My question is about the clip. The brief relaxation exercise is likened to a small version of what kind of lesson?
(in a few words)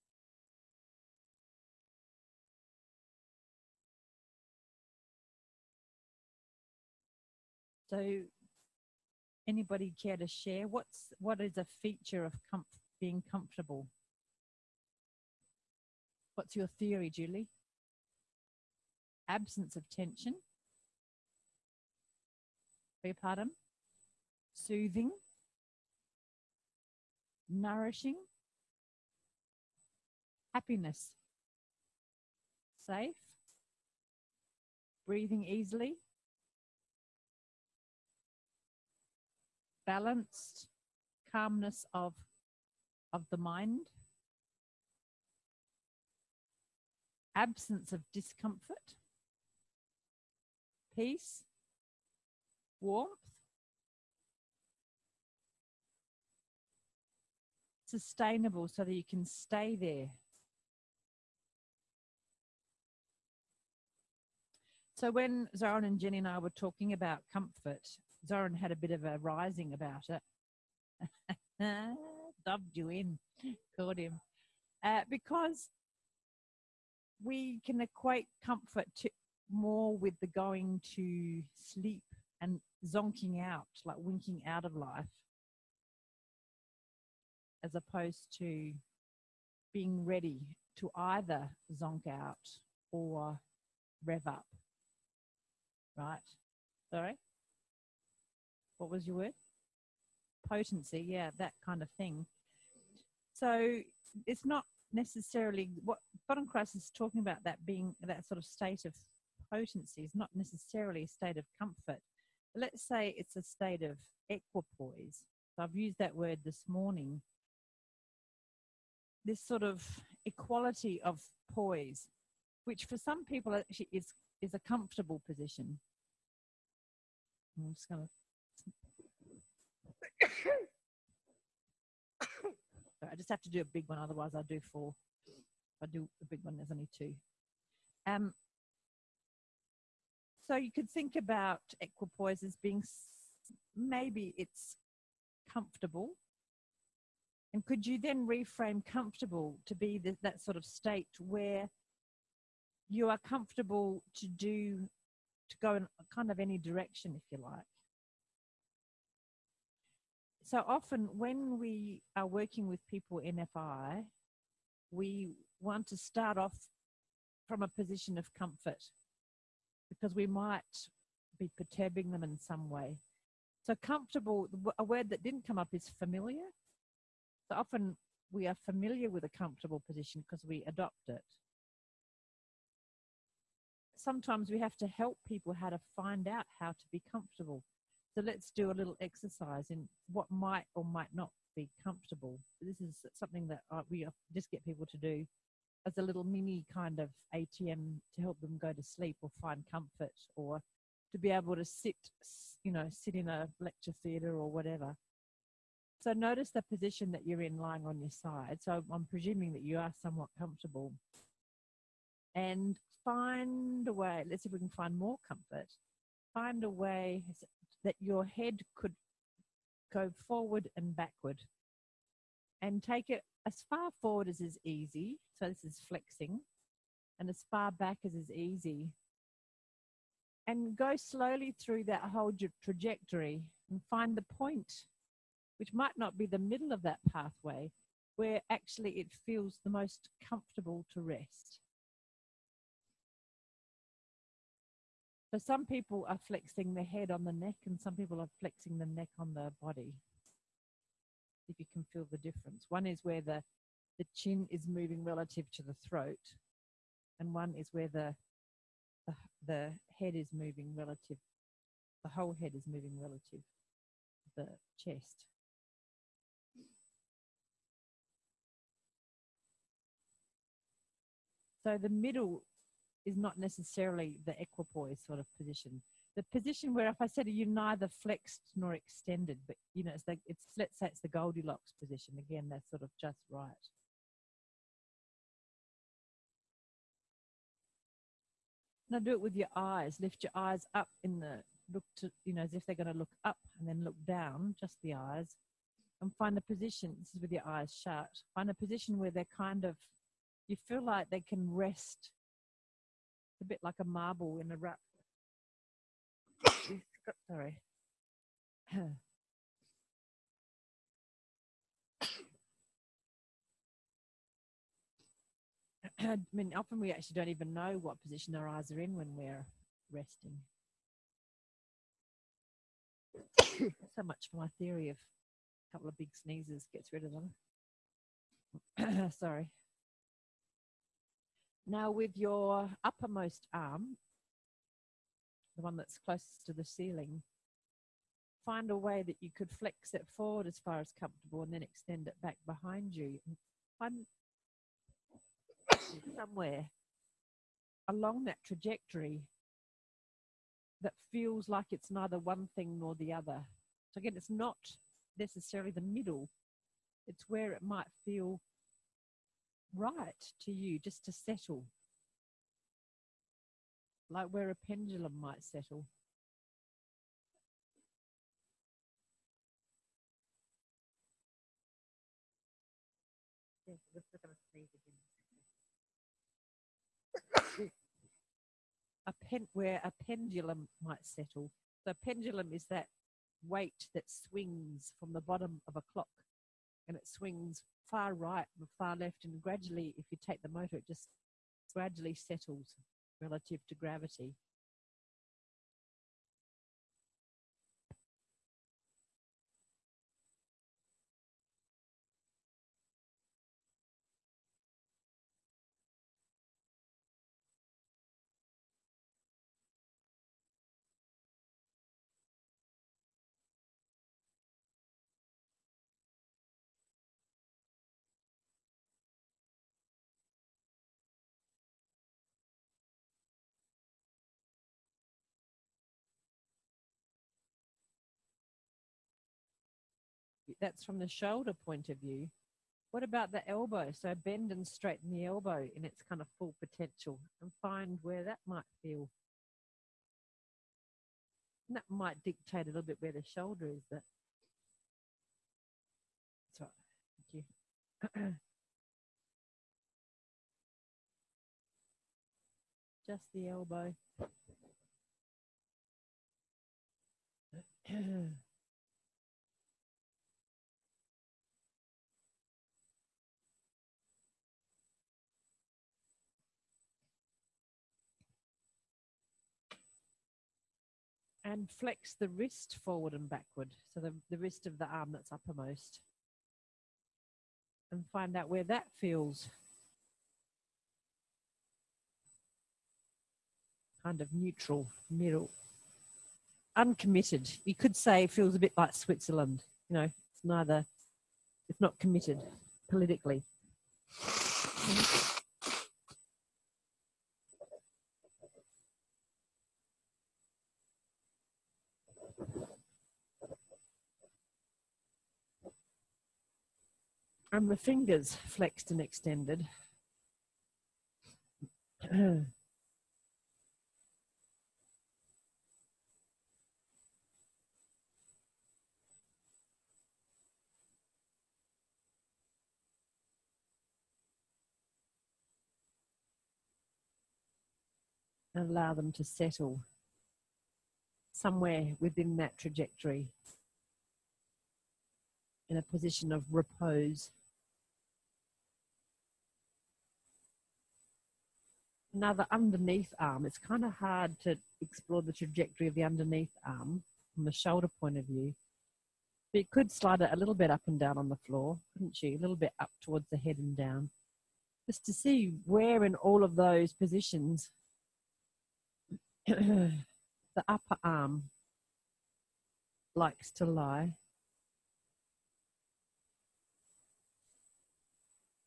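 ATM.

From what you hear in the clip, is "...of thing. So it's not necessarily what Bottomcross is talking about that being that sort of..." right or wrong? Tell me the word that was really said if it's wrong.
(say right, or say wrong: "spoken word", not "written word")
right.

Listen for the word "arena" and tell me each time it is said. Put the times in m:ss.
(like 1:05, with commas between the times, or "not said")
not said.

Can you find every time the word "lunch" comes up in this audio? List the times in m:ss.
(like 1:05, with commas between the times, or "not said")
not said.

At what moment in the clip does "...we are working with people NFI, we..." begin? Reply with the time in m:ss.
2:41.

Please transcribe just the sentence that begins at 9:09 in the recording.
But you could slide it a little bit up and down on the floor, couldn't you?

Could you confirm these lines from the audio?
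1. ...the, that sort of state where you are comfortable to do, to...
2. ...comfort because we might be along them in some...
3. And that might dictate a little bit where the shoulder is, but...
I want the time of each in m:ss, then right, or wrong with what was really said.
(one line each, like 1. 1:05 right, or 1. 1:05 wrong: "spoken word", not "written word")
1. 2:29 right
2. 2:48 wrong: "perturbing", not "along"
3. 7:21 right.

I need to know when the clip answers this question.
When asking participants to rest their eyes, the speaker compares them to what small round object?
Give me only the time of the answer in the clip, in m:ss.
5:03.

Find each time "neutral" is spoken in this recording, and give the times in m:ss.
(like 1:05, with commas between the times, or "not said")
8:04.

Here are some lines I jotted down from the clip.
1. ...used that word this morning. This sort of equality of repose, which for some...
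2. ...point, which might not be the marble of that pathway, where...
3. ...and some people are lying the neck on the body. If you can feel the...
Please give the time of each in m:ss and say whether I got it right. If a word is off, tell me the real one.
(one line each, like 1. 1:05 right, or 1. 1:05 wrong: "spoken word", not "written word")
1. 1:55 wrong: "poise", not "repose"
2. 3:54 wrong: "middle", not "marble"
3. 4:07 wrong: "flexing", not "lying".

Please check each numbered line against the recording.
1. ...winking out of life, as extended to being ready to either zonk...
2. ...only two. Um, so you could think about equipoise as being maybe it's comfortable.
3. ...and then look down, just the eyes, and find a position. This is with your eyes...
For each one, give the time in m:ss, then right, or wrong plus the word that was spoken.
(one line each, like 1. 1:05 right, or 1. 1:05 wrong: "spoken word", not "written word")
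1. 1:23 wrong: "opposed", not "extended"
2. 2:16 right
3. 4:53 right.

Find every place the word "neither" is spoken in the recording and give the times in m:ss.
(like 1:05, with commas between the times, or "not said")
4:37, 5:51, 8:10.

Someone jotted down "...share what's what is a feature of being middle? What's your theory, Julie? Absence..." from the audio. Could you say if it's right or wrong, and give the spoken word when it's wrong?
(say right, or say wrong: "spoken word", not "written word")
wrong: "comfortable", not "middle".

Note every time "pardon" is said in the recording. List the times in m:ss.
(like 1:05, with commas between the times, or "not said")
0:23.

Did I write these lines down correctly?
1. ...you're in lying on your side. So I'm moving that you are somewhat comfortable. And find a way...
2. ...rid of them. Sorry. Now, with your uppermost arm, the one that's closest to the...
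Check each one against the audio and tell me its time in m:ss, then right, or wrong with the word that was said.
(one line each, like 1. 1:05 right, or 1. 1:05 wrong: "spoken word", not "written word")
1. 3:27 wrong: "presuming", not "moving"
2. 5:26 right.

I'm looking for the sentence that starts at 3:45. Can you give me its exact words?
So this is flexing and as far back as is easy.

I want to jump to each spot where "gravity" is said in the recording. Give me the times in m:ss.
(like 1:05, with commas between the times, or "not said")
6:33.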